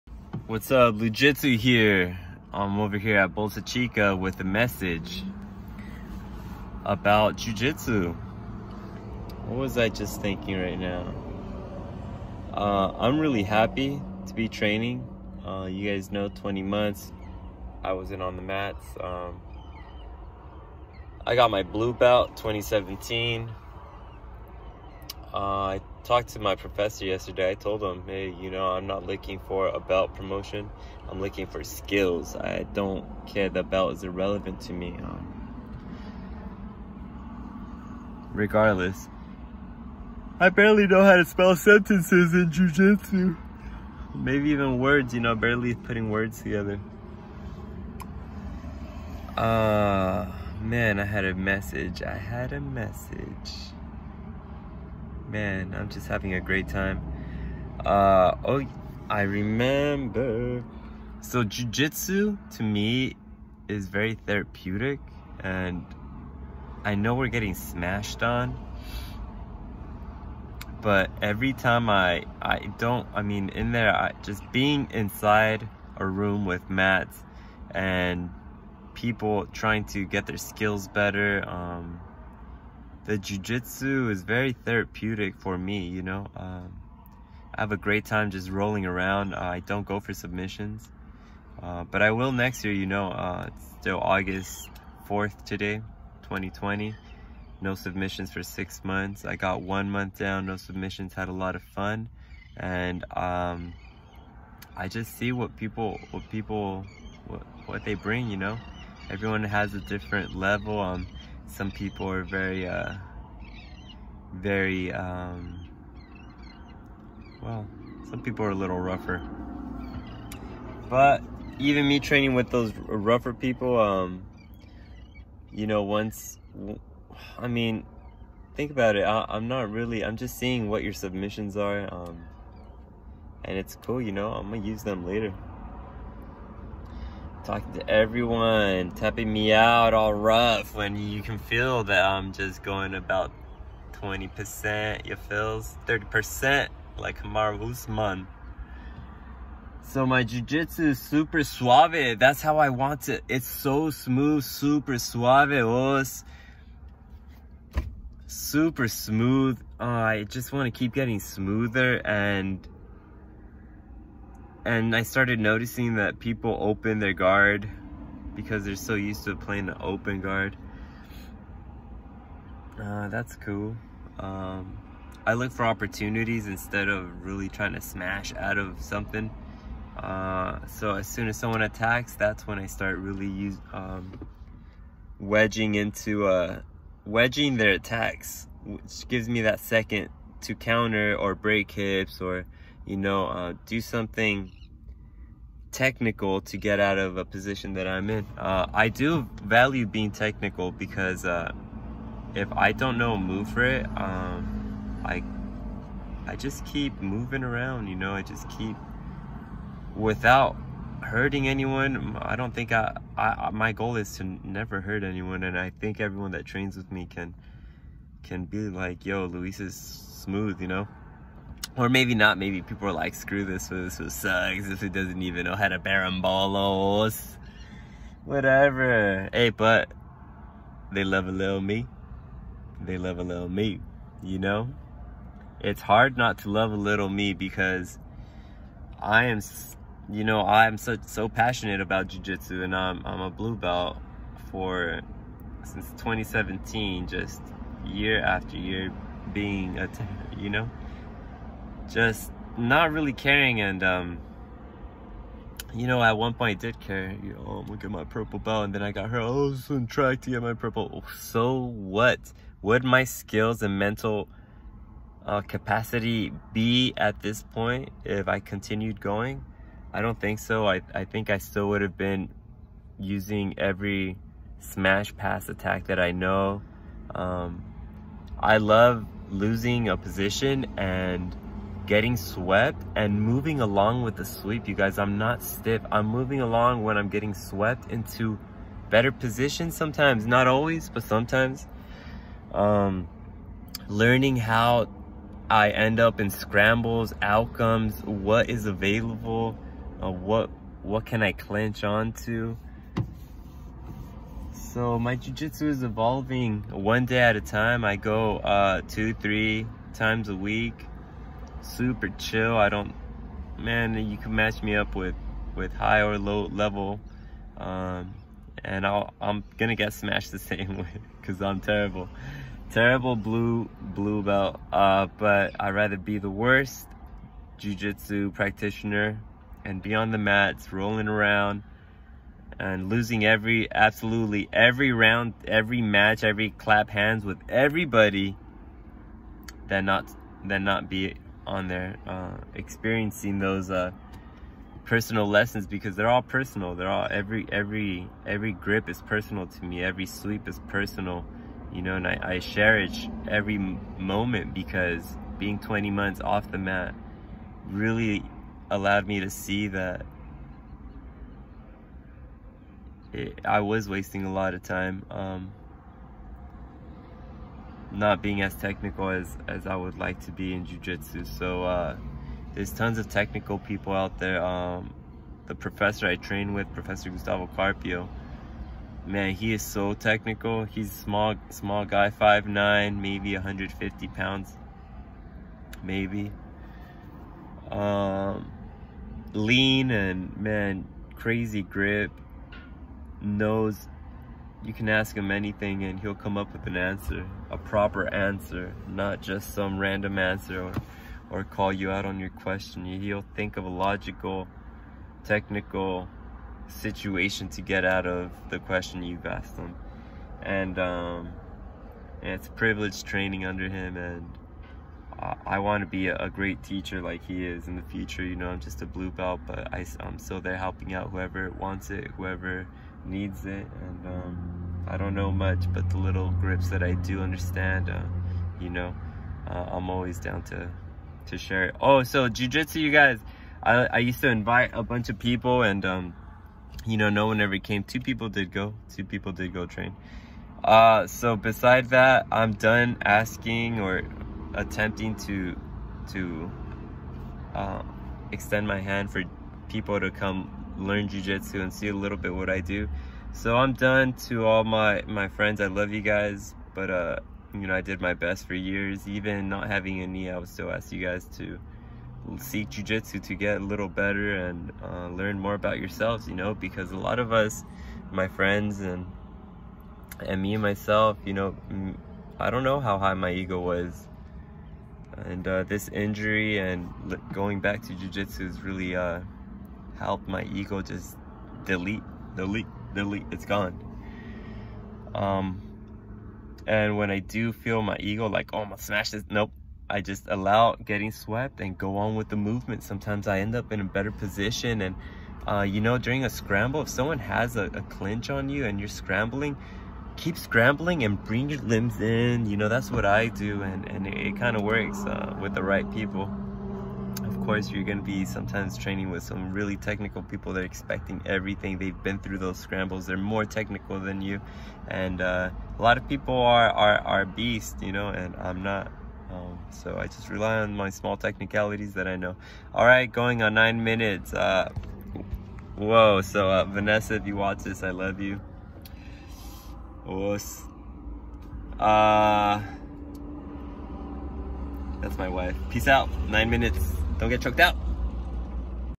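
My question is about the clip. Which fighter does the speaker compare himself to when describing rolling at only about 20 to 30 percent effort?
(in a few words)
Kamaru Usman.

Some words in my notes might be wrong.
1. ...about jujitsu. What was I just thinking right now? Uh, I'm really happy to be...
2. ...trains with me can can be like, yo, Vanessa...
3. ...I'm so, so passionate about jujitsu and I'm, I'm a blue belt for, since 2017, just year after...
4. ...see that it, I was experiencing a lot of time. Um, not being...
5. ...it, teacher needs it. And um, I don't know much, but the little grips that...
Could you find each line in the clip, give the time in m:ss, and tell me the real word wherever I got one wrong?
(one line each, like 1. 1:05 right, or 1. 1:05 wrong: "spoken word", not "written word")
1. 0:06 right
2. 3:36 wrong: "Luis", not "Vanessa"
3. 4:00 right
4. 5:59 wrong: "wasting", not "experiencing"
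5. 7:01 wrong: "whoever", not "teacher".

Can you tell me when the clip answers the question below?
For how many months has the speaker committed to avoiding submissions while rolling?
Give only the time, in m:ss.
1:38.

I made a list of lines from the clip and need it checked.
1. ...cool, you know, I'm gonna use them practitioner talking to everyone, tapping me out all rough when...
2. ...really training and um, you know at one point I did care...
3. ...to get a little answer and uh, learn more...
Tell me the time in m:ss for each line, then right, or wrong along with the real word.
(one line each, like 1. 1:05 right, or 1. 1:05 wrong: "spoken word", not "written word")
1. 2:13 wrong: "later", not "practitioner"
2. 4:12 wrong: "caring", not "training"
3. 7:43 wrong: "better", not "answer".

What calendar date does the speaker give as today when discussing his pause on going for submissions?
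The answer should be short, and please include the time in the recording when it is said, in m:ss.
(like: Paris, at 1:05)
August 4th, 2020, at 1:33.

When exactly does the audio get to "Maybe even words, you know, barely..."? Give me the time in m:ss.
0:44.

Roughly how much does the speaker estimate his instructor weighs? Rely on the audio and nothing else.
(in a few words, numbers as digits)
150 pounds.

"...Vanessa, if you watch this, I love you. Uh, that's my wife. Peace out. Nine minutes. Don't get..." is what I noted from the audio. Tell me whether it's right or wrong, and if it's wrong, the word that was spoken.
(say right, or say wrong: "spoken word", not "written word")
right.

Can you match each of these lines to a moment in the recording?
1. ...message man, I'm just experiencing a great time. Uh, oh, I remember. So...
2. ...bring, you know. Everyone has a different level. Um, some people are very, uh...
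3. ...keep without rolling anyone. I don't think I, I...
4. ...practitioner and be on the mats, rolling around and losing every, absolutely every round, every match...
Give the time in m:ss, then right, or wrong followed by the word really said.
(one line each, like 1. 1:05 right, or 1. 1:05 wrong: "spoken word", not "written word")
1. 0:52 wrong: "having", not "experiencing"
2. 1:47 right
3. 3:28 wrong: "hurting", not "rolling"
4. 5:28 right.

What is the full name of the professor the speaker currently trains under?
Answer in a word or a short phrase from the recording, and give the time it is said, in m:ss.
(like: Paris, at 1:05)
Gustavo Carpio, at 6:17.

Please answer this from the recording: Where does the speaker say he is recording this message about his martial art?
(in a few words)
Bolsa Chica.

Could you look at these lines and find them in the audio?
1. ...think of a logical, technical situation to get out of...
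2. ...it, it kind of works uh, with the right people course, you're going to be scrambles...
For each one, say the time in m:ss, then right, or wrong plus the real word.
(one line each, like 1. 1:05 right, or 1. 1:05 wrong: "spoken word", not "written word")
1. 6:43 right
2. 8:24 wrong: "sometimes", not "scrambles".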